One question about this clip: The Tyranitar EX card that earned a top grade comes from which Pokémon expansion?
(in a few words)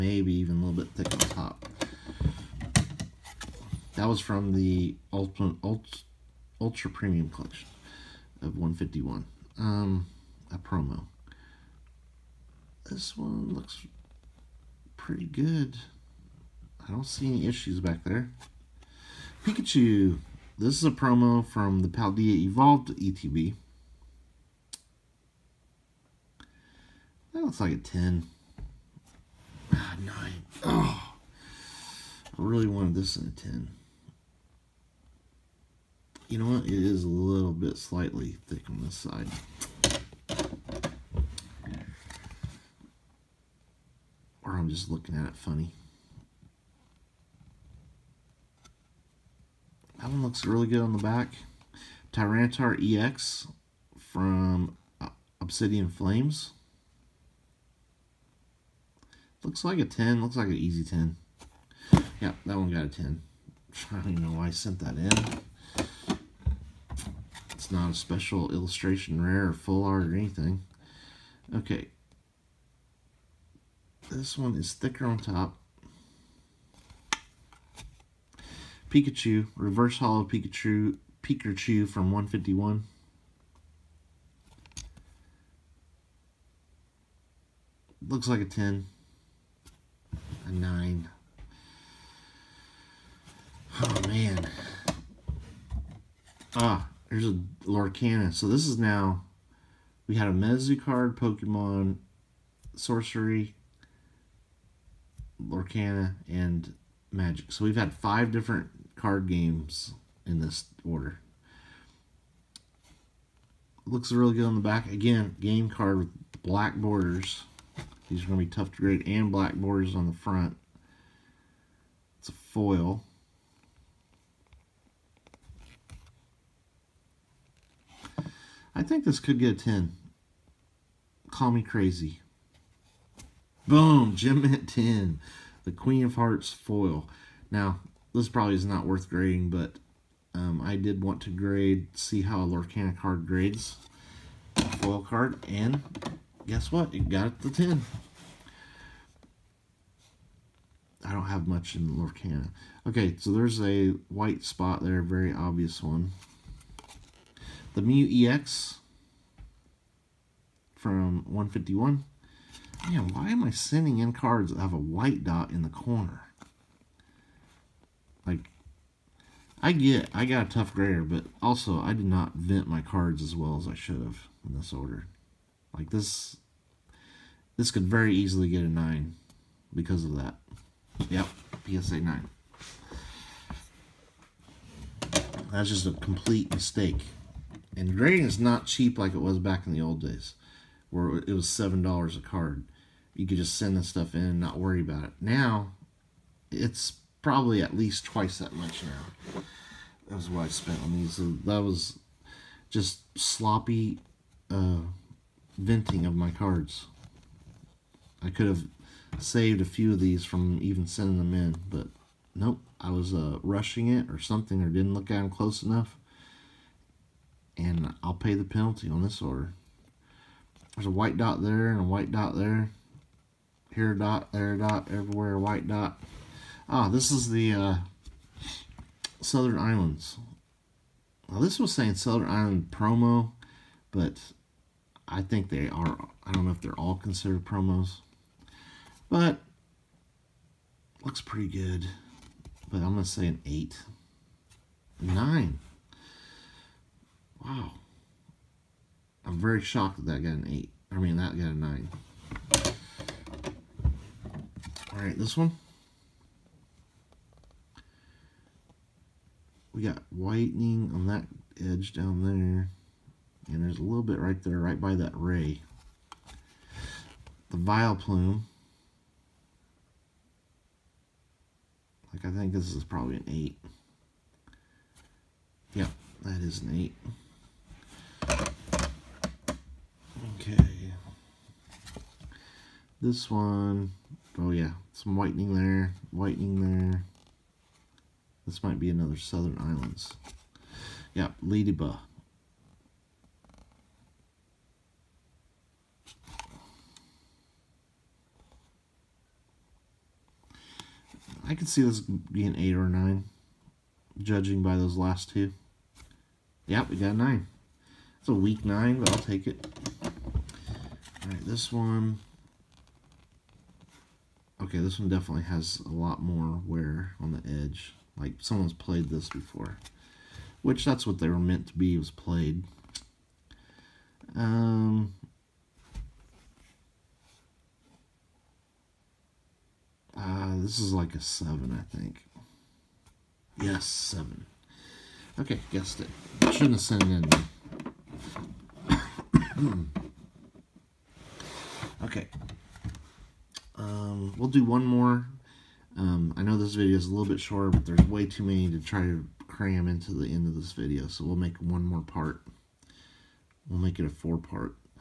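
Obsidian Flames.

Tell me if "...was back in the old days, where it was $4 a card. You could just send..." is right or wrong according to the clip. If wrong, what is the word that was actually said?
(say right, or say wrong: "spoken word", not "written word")
wrong: "7", not "4".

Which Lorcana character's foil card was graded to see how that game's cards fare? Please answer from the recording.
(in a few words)
The Queen of Hearts.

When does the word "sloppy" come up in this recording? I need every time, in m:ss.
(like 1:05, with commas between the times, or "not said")
3:23.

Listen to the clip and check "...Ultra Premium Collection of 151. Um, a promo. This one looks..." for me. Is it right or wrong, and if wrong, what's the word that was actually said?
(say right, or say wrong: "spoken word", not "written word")
right.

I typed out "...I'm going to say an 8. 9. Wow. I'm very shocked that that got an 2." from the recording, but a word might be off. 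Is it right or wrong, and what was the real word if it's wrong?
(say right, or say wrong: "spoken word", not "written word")
wrong: "8", not "2".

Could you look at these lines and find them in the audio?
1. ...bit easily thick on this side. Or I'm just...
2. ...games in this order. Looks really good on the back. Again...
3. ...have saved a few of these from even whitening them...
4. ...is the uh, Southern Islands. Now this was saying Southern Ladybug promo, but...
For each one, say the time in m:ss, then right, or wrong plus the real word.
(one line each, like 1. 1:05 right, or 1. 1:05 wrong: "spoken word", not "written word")
1. 0:37 wrong: "slightly", not "easily"
2. 1:49 right
3. 3:28 wrong: "sending", not "whitening"
4. 3:47 wrong: "Island", not "Ladybug".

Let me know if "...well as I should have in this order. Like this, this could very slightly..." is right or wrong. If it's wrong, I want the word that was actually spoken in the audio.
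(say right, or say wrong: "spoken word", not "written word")
wrong: "easily", not "slightly".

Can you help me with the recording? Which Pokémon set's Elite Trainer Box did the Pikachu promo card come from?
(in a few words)
Paldea Evolved.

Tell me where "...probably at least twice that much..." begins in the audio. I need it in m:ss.
3:17.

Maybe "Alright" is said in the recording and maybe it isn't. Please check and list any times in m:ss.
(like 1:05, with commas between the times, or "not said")
4:14, 5:11.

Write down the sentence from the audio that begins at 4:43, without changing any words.
This one, oh yeah, some whitening there, whitening there.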